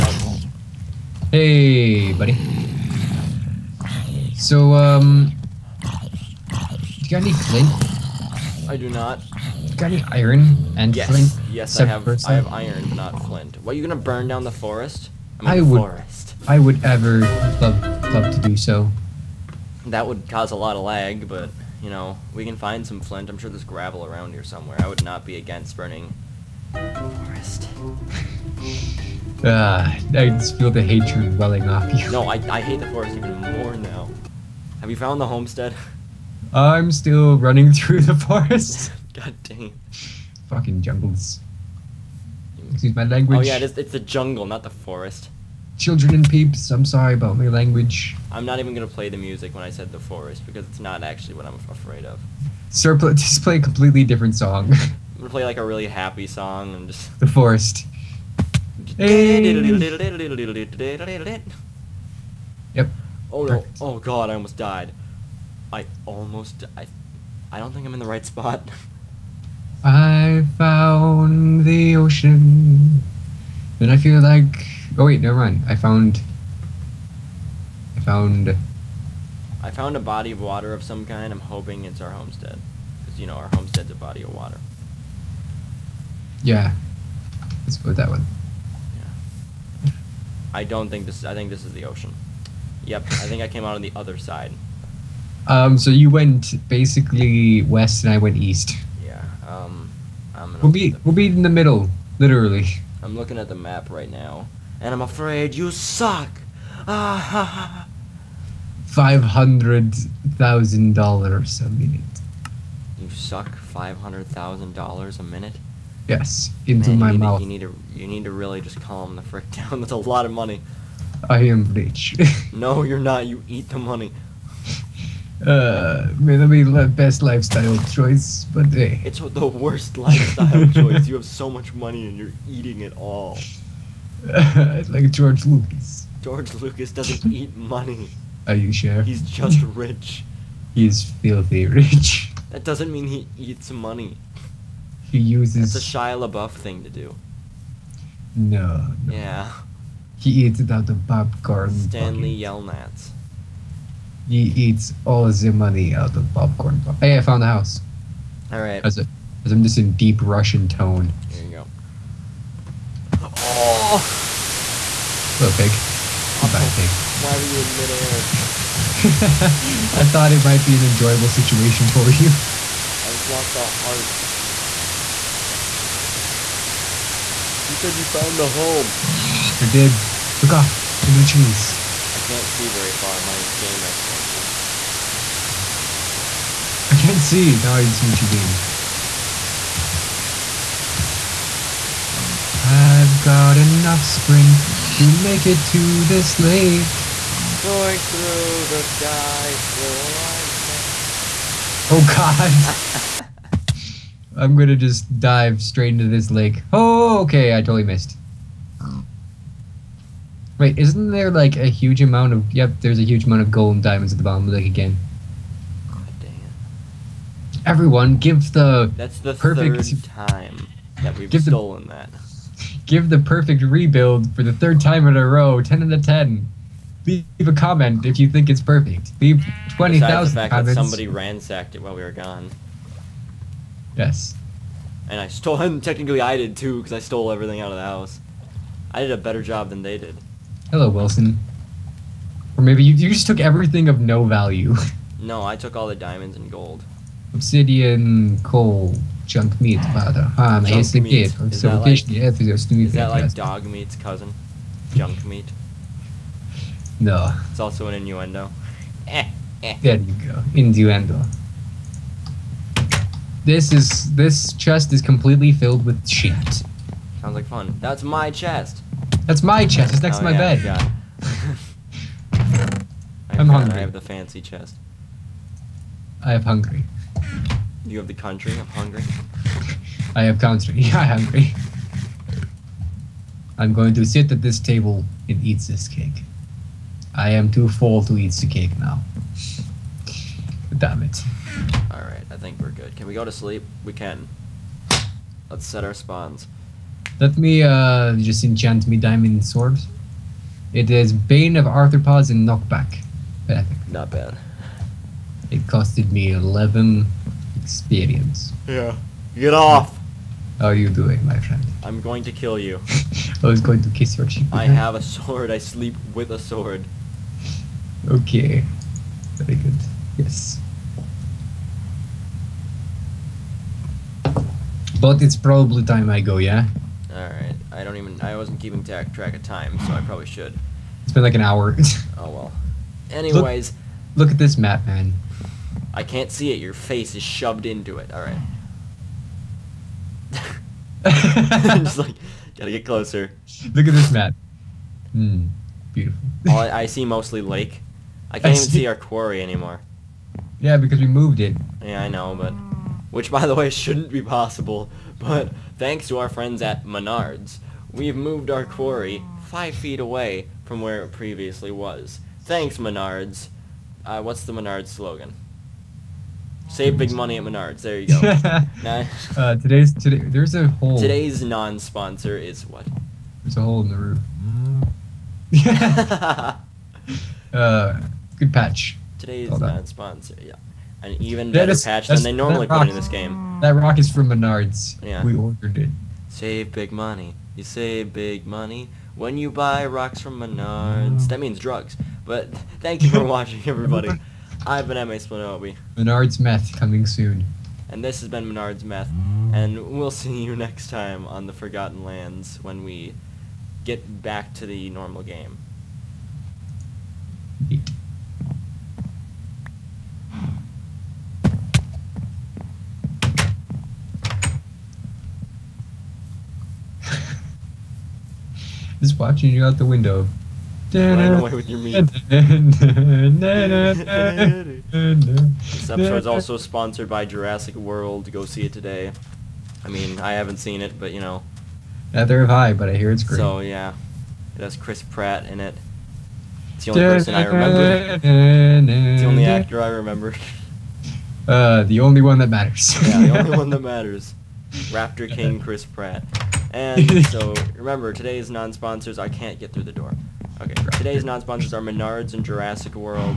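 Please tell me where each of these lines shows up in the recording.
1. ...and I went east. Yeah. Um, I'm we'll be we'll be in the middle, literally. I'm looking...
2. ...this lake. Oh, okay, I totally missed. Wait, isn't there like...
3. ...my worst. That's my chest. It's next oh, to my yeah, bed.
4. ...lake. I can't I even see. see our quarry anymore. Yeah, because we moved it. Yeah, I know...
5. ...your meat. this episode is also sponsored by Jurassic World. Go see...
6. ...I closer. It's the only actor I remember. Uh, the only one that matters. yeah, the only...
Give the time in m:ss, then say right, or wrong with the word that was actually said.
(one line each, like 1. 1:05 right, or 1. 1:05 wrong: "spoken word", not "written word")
1. 1:38 right
2. 3:26 right
3. 4:28 wrong: "chest", not "worst"
4. 5:47 right
5. 7:01 right
6. 7:17 wrong: "remember", not "closer".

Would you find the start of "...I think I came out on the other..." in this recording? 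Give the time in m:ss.
1:33.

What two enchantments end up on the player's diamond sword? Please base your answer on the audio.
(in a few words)
Bane of Arthropods and Knockback.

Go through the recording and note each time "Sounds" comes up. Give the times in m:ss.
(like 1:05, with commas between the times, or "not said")
4:27.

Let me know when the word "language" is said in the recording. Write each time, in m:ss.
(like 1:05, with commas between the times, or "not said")
0:43, 0:47.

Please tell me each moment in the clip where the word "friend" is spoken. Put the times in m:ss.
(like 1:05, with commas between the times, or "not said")
5:11, 5:56.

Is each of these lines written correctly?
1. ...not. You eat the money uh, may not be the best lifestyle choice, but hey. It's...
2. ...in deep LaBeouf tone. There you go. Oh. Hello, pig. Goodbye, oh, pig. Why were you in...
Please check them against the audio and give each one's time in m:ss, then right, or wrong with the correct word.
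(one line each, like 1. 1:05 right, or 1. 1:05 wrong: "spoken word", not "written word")
1. 2:02 right
2. 2:39 wrong: "Russian", not "LaBeouf".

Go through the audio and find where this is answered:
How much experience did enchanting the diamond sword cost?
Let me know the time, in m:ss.
5:06.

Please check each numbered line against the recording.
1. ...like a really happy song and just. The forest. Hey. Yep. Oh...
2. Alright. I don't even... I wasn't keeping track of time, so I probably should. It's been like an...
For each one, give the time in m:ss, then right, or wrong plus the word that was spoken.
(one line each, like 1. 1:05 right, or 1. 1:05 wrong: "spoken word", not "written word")
1. 0:55 right
2. 5:27 right.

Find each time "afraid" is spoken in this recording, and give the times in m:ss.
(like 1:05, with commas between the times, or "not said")
0:51, 1:45.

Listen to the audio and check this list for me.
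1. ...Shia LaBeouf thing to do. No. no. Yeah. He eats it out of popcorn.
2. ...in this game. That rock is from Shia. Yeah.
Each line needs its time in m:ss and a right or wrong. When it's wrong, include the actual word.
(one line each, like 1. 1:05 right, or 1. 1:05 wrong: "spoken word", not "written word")
1. 2:25 right
2. 6:22 wrong: "Menards", not "Shia".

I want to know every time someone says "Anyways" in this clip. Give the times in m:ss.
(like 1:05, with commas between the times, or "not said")
5:33.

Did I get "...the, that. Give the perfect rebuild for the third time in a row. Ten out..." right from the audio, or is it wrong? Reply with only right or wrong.
right.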